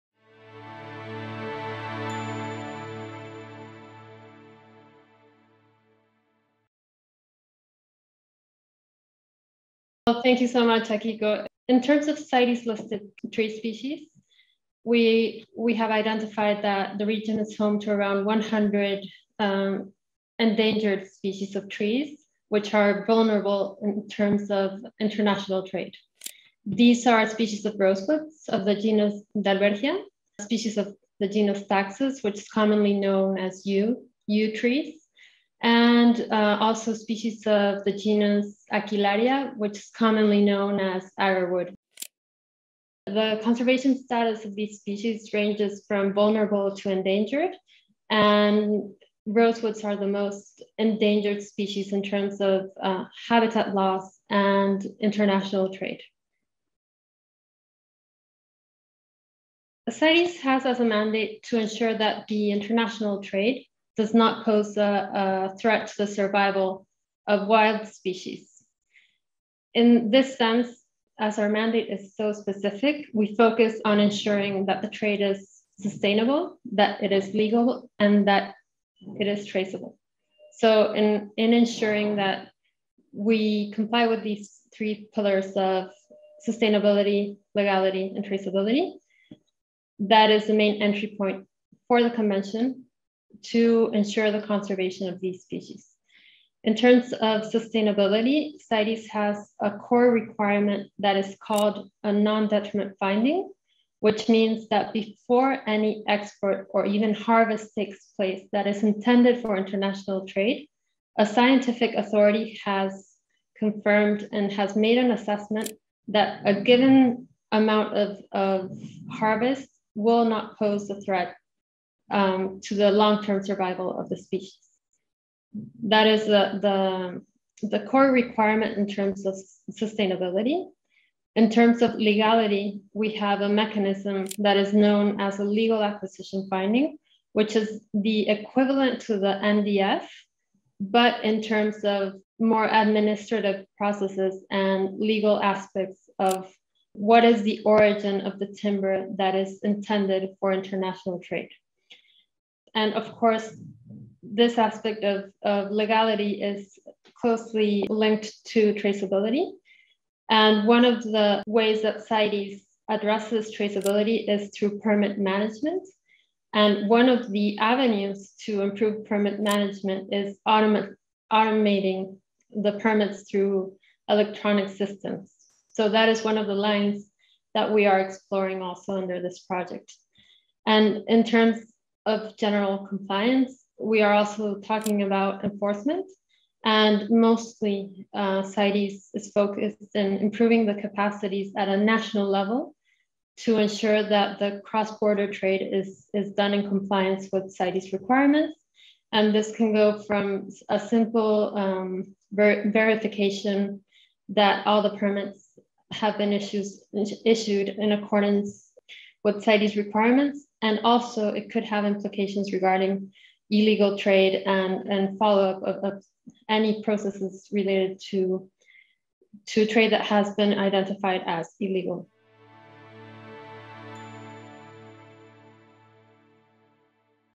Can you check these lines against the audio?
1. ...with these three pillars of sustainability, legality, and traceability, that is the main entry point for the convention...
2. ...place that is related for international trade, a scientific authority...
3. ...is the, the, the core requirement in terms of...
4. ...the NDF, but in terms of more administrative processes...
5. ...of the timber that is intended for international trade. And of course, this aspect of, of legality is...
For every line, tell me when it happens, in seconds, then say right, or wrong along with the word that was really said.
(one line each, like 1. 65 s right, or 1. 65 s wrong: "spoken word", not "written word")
1. 84 s right
2. 108 s wrong: "intended", not "related"
3. 126 s right
4. 139 s right
5. 148 s right.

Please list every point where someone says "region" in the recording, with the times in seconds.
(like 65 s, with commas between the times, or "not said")
17 s.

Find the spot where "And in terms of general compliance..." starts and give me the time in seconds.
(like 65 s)
180 s.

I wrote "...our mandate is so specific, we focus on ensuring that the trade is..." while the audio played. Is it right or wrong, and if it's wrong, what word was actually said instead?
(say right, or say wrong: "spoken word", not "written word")
right.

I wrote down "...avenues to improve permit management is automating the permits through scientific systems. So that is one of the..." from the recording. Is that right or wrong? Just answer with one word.
wrong.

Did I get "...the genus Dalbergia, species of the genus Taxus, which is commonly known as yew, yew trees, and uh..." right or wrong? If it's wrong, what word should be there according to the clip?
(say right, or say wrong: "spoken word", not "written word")
right.